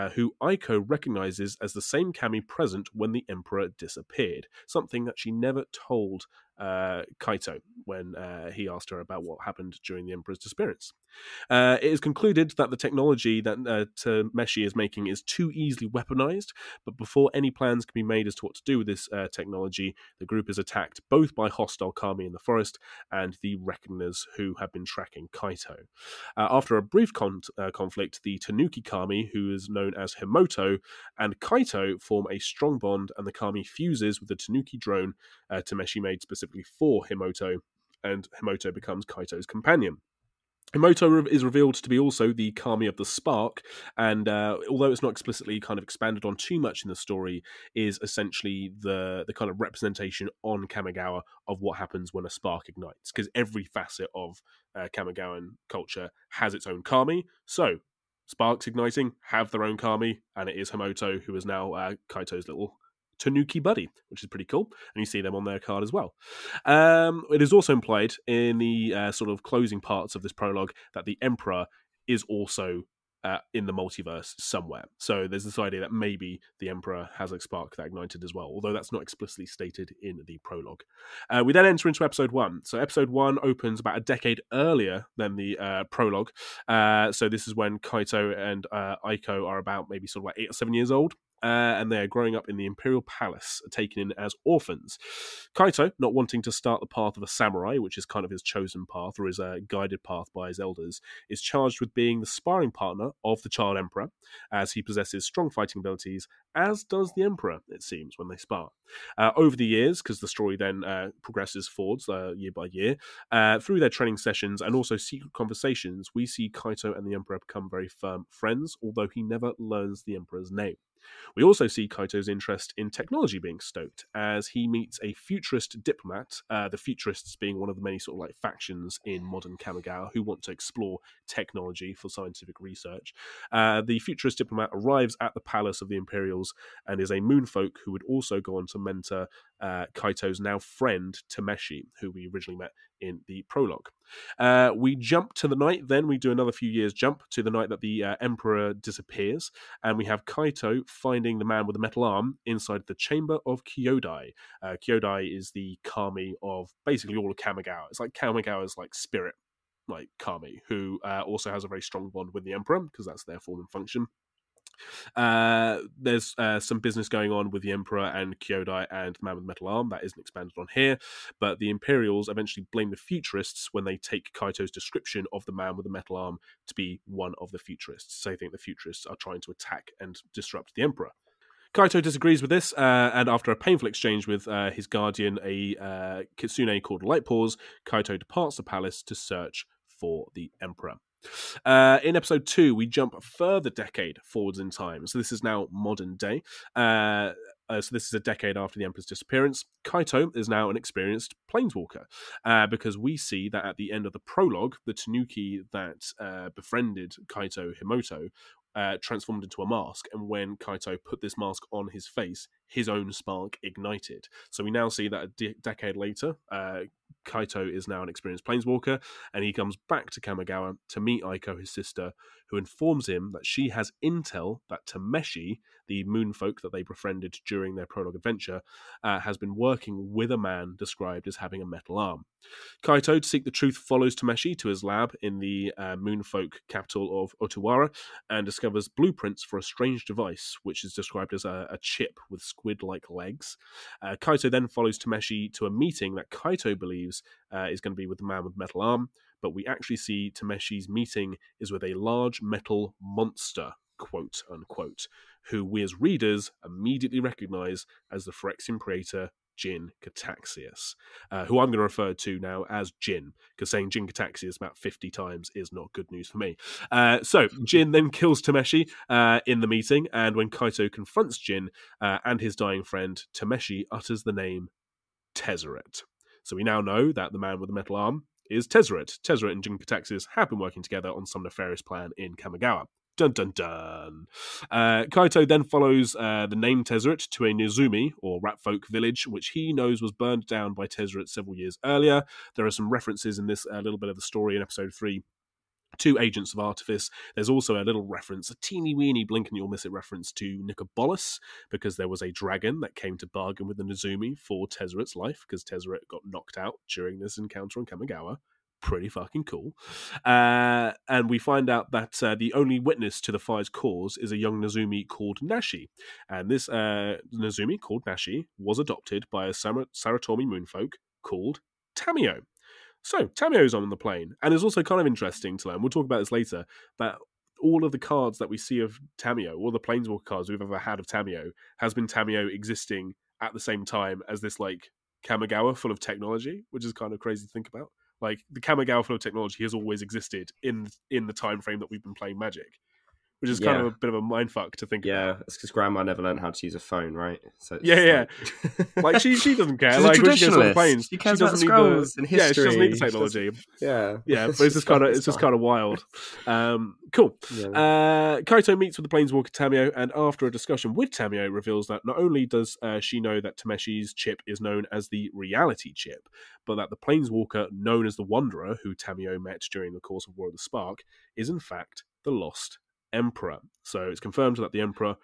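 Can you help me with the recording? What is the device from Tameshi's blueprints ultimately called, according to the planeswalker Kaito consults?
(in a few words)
Reality Chip.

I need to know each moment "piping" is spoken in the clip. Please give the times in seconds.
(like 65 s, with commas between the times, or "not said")
not said.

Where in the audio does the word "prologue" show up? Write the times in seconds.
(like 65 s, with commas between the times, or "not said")
70 s, 80 s, 85 s, 143 s, 204 s, 227 s.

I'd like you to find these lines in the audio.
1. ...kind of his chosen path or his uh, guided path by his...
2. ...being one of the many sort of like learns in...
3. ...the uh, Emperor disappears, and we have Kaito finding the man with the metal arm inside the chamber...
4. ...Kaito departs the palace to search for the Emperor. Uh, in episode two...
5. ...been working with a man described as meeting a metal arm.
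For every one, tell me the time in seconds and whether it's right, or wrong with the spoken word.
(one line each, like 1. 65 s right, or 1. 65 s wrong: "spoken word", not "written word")
1. 98 s right
2. 127 s wrong: "factions", not "learns"
3. 147 s right
4. 187 s right
5. 229 s wrong: "having", not "meeting".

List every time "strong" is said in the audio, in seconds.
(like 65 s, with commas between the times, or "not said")
32 s, 105 s, 161 s.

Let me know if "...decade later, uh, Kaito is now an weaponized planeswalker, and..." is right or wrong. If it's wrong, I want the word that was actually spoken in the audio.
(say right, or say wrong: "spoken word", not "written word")
wrong: "experienced", not "weaponized".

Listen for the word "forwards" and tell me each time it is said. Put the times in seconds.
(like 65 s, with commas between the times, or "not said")
111 s, 194 s.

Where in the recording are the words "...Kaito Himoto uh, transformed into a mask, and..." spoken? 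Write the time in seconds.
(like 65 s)
207 s.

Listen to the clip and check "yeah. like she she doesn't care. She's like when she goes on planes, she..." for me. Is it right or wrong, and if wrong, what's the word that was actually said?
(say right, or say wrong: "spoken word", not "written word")
right.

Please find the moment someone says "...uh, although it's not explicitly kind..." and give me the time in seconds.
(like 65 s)
44 s.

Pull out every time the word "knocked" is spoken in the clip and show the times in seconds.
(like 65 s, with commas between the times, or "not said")
306 s.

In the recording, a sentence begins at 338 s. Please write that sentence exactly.
Like the Kamigawa flow technology has always existed in in the time frame that we've been playing Magic which is kind yeah.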